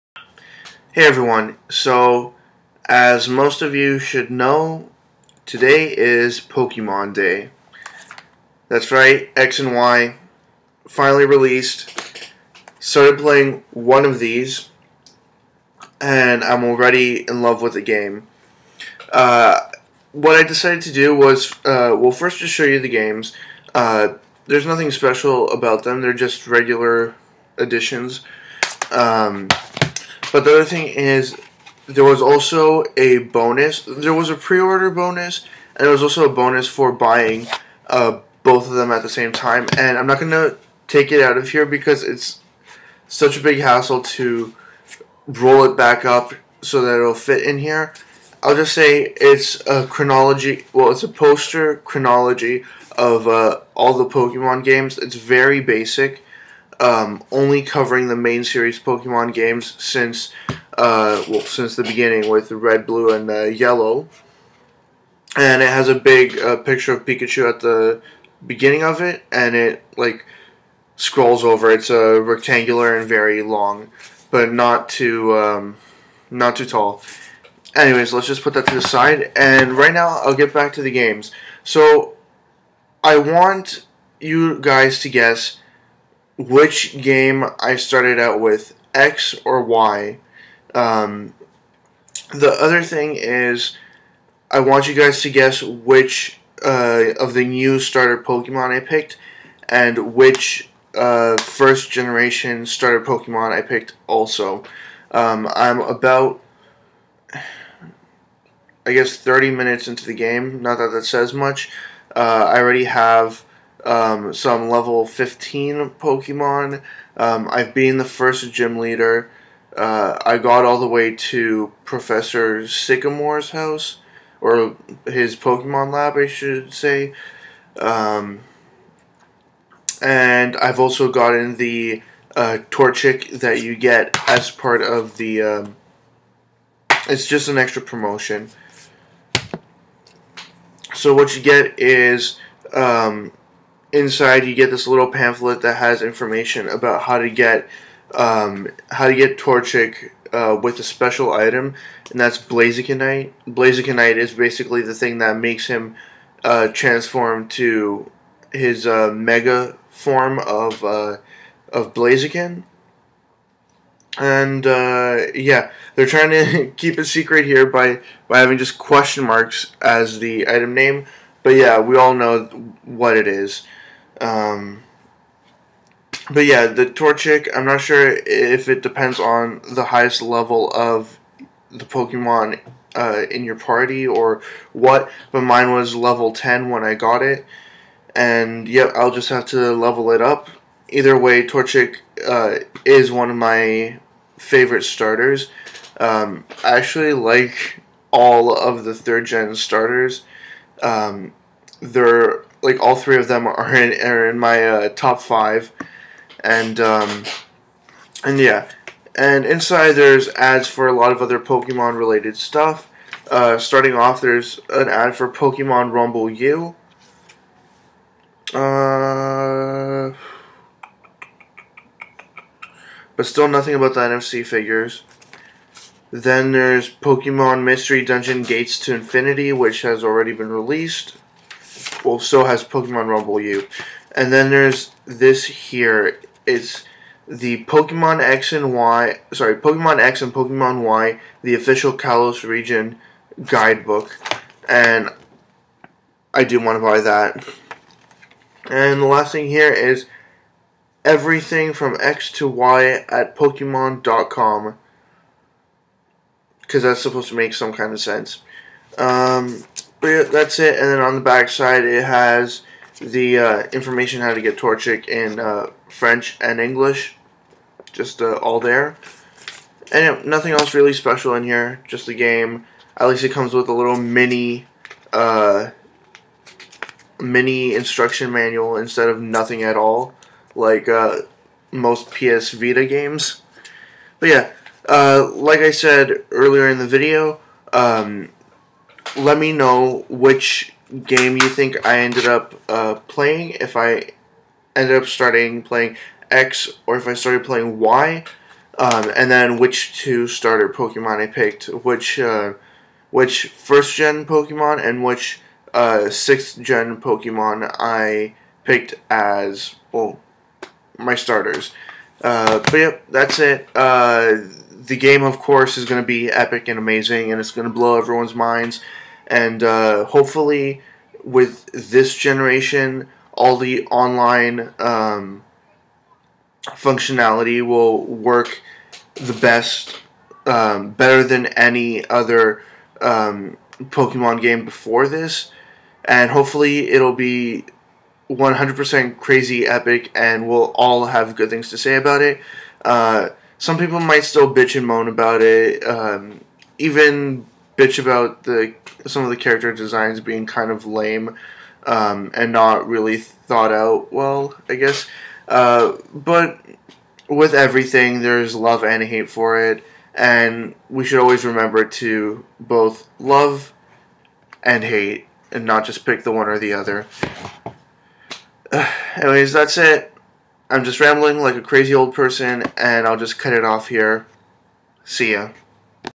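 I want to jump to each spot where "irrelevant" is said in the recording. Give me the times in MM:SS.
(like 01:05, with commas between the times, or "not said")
not said.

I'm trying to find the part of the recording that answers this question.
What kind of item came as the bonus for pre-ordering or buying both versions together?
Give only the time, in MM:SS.
00:51.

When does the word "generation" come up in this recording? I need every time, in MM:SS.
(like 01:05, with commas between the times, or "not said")
01:41, 05:22.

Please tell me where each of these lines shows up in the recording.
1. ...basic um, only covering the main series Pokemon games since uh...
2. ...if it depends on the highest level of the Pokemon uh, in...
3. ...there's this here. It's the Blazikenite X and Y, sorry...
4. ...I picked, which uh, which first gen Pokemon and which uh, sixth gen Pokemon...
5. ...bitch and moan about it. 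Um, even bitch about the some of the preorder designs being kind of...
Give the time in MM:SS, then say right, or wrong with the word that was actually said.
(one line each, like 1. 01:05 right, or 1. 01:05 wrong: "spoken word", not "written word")
1. 00:55 right
2. 02:58 right
3. 03:54 wrong: "Pokemon", not "Blazikenite"
4. 05:01 right
5. 05:44 wrong: "character", not "preorder".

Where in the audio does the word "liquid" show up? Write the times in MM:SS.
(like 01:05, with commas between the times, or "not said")
not said.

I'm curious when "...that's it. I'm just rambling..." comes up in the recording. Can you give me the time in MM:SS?
06:09.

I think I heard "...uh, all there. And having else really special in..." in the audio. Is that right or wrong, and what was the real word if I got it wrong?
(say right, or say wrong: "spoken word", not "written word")
wrong: "nothing", not "having".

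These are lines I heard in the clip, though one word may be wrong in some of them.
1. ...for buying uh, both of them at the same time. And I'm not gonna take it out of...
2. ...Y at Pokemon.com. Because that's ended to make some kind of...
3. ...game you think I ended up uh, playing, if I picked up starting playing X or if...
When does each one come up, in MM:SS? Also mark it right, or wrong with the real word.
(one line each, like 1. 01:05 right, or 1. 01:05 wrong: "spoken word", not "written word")
1. 00:36 right
2. 04:12 wrong: "supposed", not "ended"
3. 04:51 wrong: "ended", not "picked".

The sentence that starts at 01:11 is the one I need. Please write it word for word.
It's a rectangular and very long, but not too um, not too tall.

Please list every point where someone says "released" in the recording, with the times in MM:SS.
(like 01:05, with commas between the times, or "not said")
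00:11, 03:50.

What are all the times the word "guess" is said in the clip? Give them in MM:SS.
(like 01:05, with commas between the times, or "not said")
01:25, 01:35, 01:48, 05:54.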